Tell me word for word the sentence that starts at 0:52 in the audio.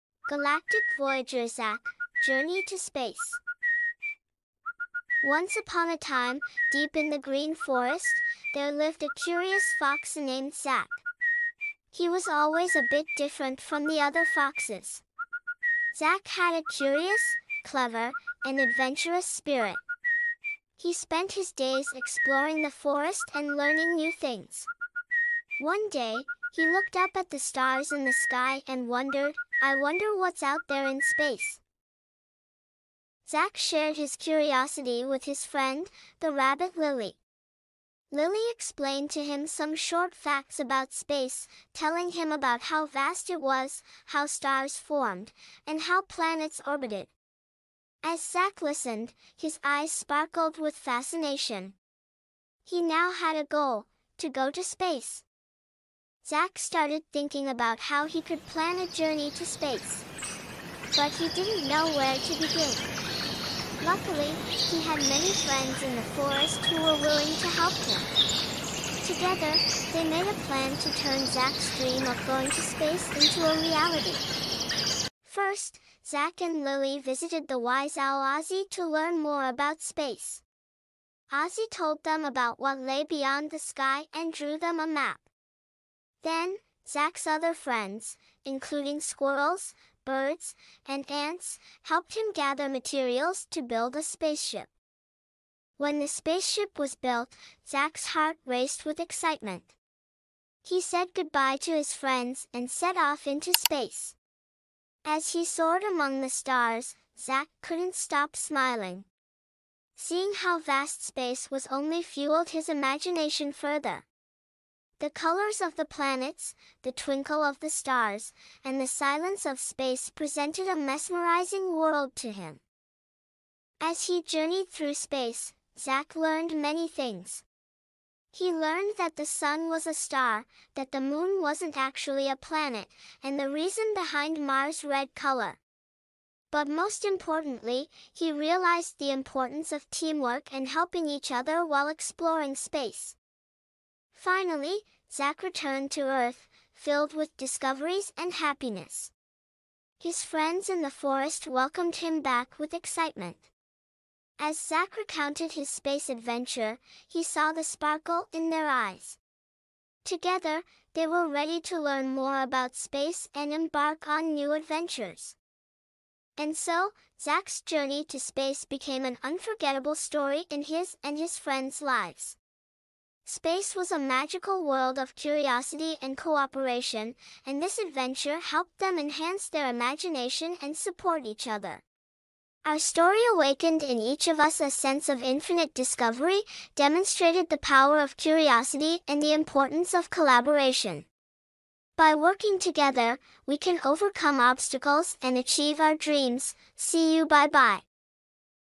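He now had a goal, to go to space.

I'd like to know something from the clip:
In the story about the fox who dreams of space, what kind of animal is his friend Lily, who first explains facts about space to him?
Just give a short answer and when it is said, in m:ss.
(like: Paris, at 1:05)
Rabbit, at 0:36.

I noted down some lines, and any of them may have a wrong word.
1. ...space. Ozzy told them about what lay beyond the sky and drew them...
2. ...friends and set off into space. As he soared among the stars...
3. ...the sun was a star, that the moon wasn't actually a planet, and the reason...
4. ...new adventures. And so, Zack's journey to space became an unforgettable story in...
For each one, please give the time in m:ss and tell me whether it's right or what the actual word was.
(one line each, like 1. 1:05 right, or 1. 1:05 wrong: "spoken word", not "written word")
1. 1:19 right
2. 1:41 right
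3. 2:09 right
4. 2:44 right.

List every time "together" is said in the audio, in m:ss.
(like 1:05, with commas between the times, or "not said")
1:09, 2:40, 3:12.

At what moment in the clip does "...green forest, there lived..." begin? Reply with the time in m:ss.
0:07.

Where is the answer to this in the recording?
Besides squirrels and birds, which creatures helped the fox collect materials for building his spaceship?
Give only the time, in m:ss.
1:31.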